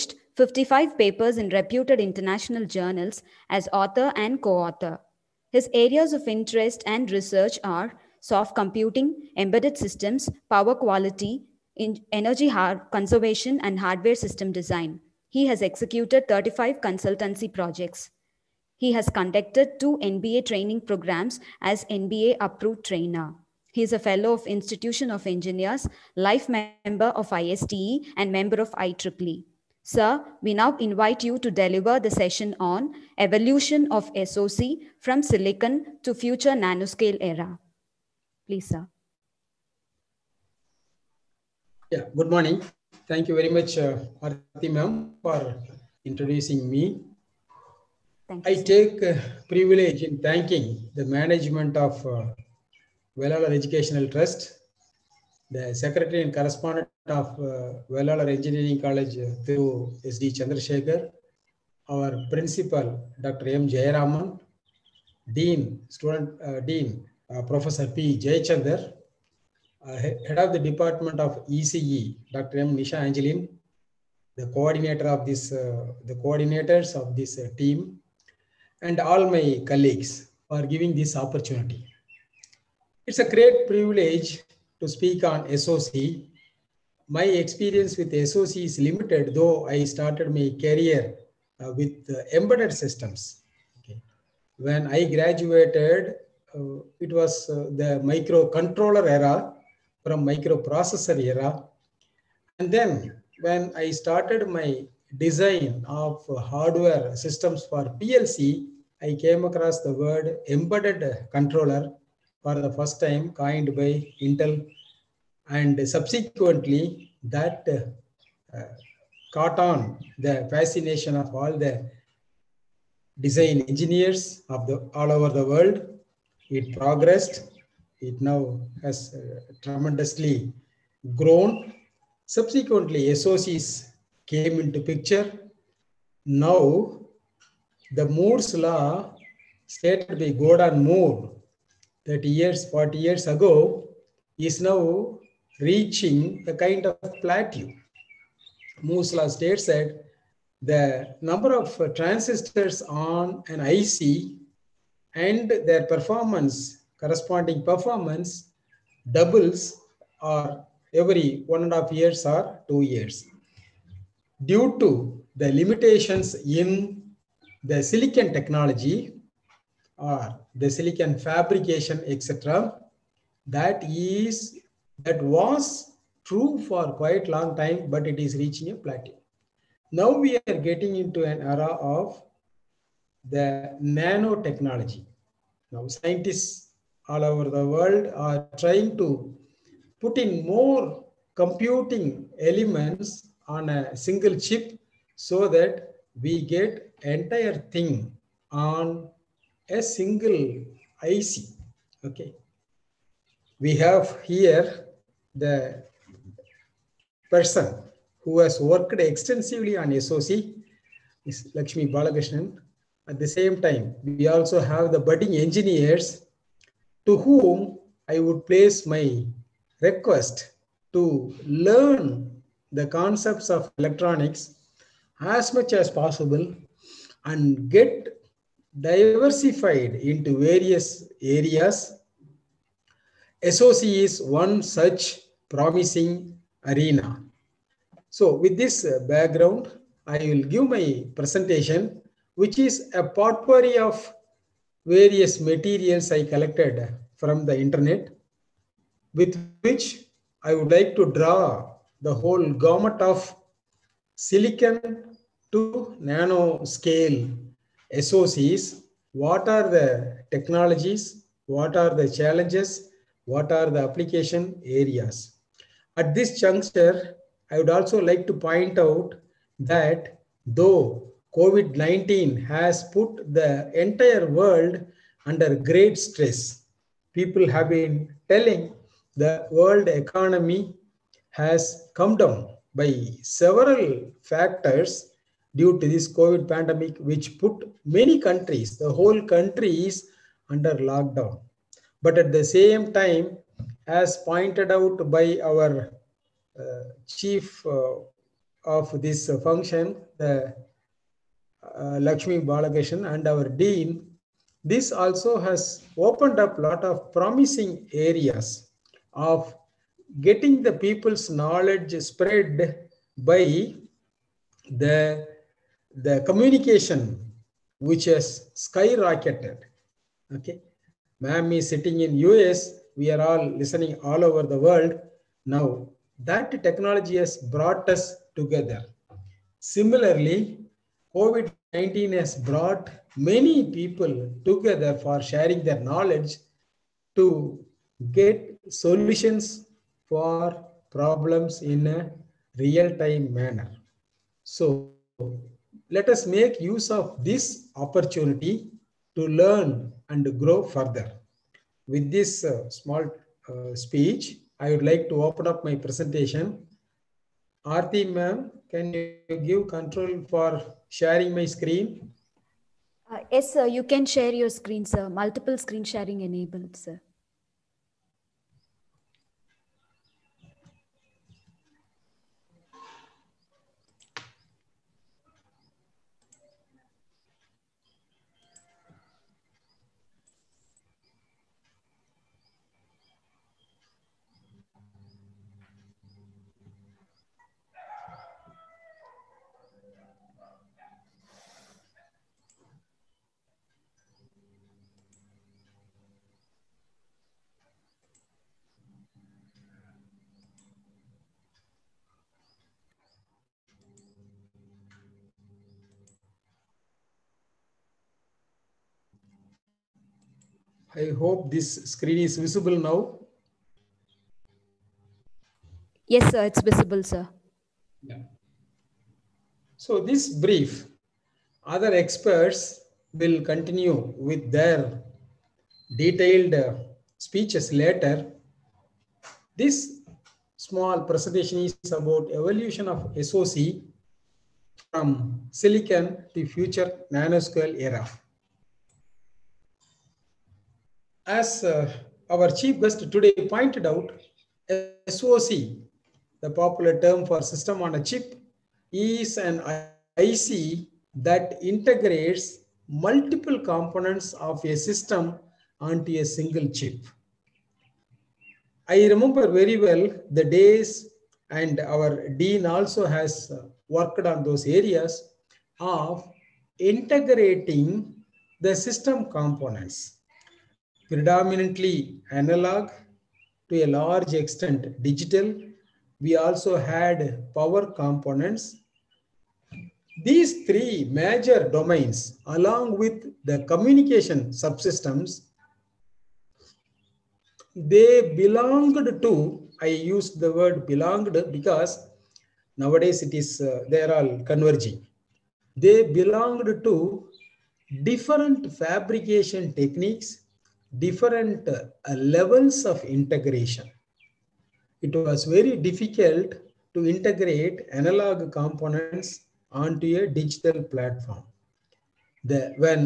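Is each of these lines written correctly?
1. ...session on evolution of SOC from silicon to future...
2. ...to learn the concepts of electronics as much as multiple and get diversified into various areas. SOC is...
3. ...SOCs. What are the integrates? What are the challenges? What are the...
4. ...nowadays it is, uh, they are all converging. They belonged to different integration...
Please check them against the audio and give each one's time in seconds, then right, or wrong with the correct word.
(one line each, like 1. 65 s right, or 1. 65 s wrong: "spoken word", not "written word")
1. 32 s right
2. 220 s wrong: "possible", not "multiple"
3. 257 s wrong: "technologies", not "integrates"
4. 492 s wrong: "fabrication", not "integration".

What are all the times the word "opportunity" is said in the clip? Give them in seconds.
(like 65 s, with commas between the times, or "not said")
81 s, 347 s.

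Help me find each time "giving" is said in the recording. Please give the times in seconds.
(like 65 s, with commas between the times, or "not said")
80 s.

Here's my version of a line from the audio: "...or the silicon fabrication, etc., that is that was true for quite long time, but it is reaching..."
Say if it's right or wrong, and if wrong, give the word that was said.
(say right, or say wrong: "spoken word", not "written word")
right.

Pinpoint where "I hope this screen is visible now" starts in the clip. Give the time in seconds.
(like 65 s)
410 s.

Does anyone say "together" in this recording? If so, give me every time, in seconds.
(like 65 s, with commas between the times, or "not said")
328 s, 334 s.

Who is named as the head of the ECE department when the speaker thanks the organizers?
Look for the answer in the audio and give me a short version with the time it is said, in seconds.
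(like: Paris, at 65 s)
Dr. M. Nisha Angelin, at 72 s.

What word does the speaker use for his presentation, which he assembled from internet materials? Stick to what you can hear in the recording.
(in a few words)
potpourri.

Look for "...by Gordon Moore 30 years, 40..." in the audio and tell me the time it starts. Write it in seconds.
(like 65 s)
140 s.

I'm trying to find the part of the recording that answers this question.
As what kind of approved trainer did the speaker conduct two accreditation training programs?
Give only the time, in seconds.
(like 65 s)
21 s.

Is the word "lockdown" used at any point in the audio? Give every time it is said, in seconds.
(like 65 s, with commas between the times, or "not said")
290 s.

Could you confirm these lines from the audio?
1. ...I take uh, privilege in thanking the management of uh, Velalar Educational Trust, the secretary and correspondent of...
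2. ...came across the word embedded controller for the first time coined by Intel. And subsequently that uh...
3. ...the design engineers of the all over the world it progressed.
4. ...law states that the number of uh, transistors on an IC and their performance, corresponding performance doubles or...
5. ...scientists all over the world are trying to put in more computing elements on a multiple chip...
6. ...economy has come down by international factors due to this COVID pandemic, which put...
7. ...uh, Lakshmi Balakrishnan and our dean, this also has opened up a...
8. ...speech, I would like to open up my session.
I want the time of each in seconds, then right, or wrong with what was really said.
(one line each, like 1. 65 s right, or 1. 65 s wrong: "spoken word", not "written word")
1. 48 s right
2. 109 s right
3. 121 s right
4. 149 s right
5. 185 s wrong: "single", not "multiple"
6. 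279 s wrong: "several", not "international"
7. 301 s right
8. 353 s wrong: "presentation", not "session".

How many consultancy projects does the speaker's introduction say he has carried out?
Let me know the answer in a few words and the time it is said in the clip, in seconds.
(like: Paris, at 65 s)
35, at 16 s.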